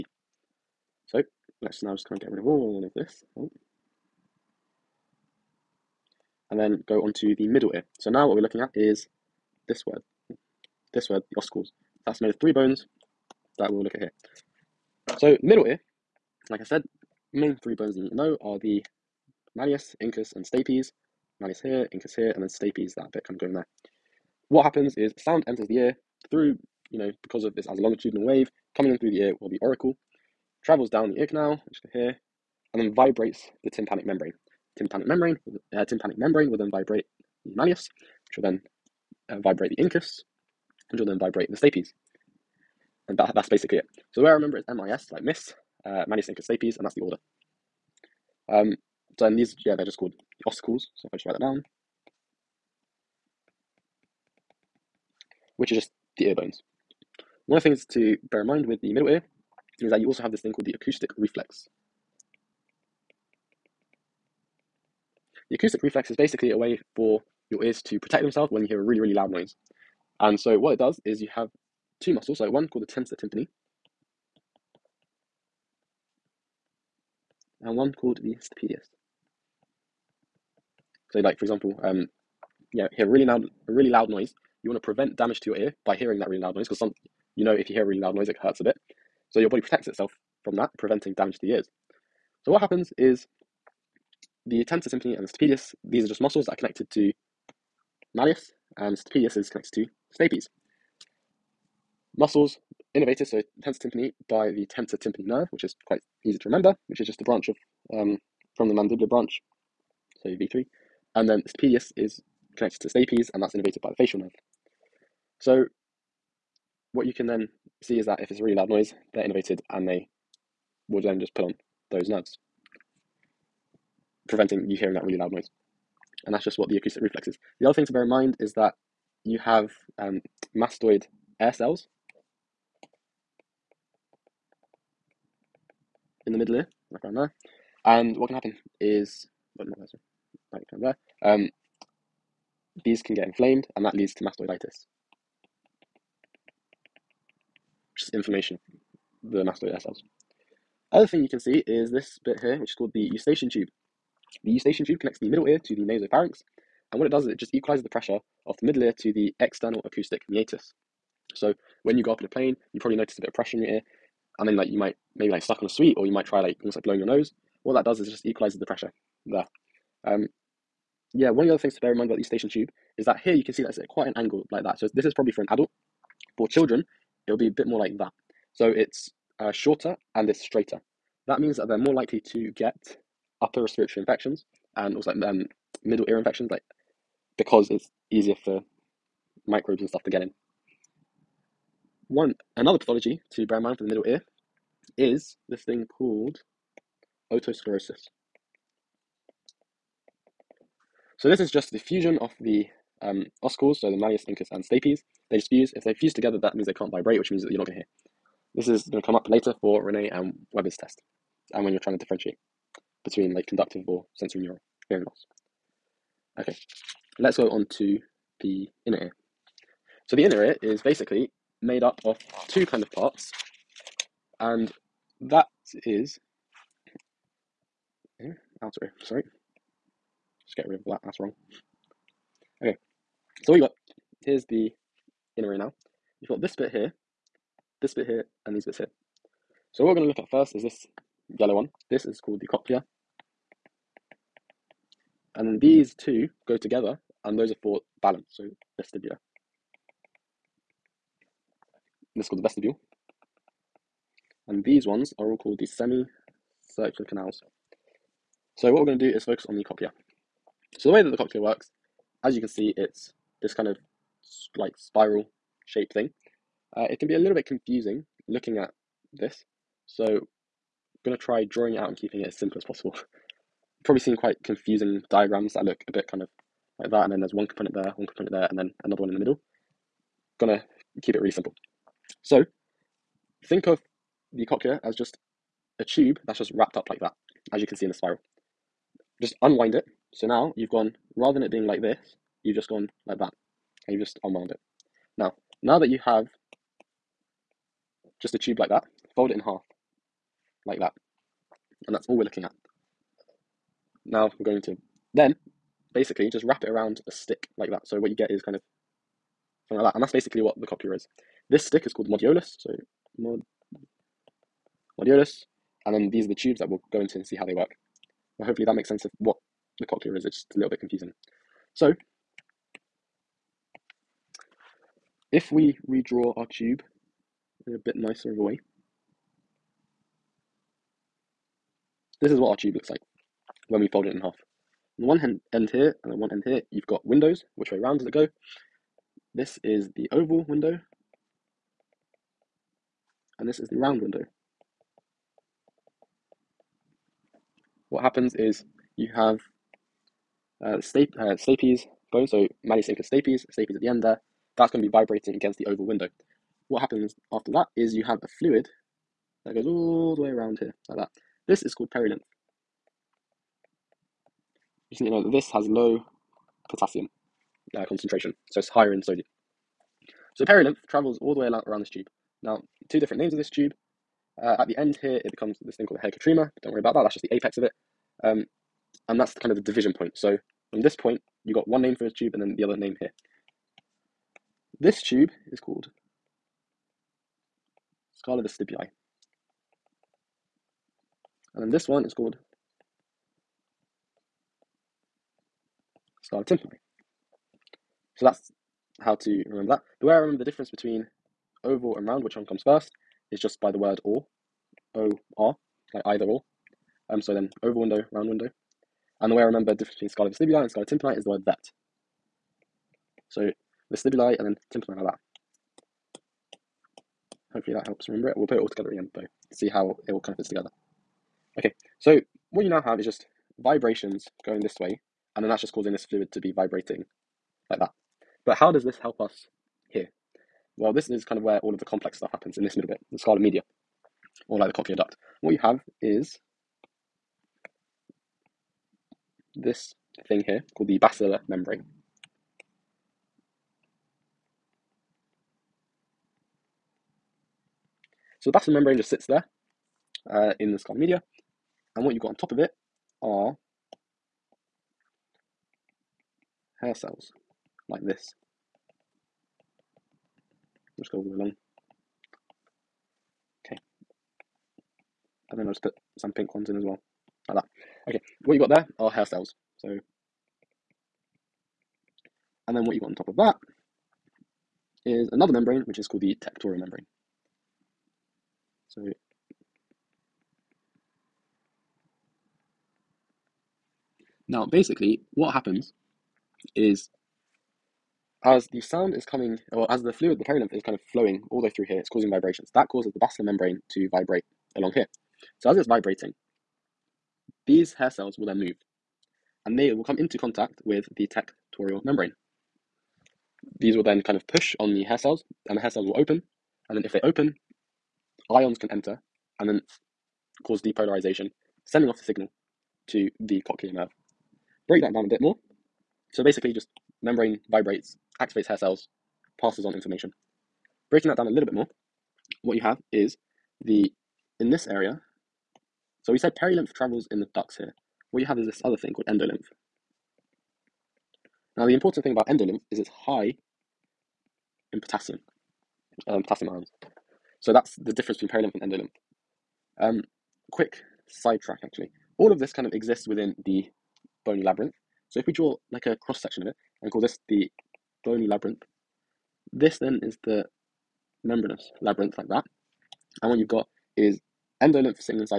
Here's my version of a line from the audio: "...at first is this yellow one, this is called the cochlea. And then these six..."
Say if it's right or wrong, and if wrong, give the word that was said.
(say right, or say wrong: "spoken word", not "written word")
wrong: "two", not "six".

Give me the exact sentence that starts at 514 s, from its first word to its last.
Break that down a bit more.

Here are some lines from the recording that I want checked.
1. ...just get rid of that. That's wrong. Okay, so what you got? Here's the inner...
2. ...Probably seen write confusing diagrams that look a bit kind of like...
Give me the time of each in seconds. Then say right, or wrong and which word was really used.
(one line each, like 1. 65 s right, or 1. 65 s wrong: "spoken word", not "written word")
1. 230 s right
2. 273 s wrong: "quite", not "write".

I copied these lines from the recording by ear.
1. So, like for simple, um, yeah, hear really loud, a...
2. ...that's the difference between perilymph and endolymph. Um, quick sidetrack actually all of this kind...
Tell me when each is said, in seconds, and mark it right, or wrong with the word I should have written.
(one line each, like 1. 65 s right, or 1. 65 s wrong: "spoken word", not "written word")
1. 81 s wrong: "example", not "simple"
2. 537 s right.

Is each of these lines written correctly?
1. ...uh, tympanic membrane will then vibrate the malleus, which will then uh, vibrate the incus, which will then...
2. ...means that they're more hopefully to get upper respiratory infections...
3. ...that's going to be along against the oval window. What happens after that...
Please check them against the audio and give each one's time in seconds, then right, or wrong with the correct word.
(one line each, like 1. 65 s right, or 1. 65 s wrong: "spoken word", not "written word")
1. 35 s right
2. 181 s wrong: "likely", not "hopefully"
3. 354 s wrong: "vibrating", not "along".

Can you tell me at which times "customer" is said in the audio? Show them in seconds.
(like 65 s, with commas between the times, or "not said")
not said.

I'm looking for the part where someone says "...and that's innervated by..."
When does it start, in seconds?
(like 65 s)
113 s.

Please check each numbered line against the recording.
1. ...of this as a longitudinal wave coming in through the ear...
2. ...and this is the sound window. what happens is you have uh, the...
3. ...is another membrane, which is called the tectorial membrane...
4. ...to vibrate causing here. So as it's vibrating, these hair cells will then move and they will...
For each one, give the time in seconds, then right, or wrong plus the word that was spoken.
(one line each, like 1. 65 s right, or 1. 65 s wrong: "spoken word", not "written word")
1. 27 s right
2. 343 s wrong: "round", not "sound"
3. 475 s right
4. 493 s wrong: "along", not "causing".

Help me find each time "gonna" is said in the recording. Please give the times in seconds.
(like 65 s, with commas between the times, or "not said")
271 s, 280 s.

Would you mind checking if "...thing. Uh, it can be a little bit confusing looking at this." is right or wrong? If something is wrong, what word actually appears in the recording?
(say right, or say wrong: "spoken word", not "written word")
right.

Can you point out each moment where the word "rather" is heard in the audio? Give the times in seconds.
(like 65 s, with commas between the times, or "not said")
291 s.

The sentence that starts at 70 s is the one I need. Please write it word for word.
And so what it does is you have two muscles, like one called the tensor tympani.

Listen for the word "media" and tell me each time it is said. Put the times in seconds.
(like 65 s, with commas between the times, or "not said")
433 s, 450 s.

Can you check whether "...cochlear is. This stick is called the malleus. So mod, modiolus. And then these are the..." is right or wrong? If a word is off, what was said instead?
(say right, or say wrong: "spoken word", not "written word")
wrong: "modiolus", not "malleus".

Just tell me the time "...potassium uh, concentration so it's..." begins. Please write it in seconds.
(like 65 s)
366 s.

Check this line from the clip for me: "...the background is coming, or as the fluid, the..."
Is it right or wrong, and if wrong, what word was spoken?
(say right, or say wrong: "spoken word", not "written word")
wrong: "sound", not "background".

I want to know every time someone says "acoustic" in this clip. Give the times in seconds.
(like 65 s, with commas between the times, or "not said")
60 s, 65 s, 126 s, 159 s.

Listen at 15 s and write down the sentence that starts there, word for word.
So middle ear, like I said, main three bones that you need to know are the malleus, incus, and stapes.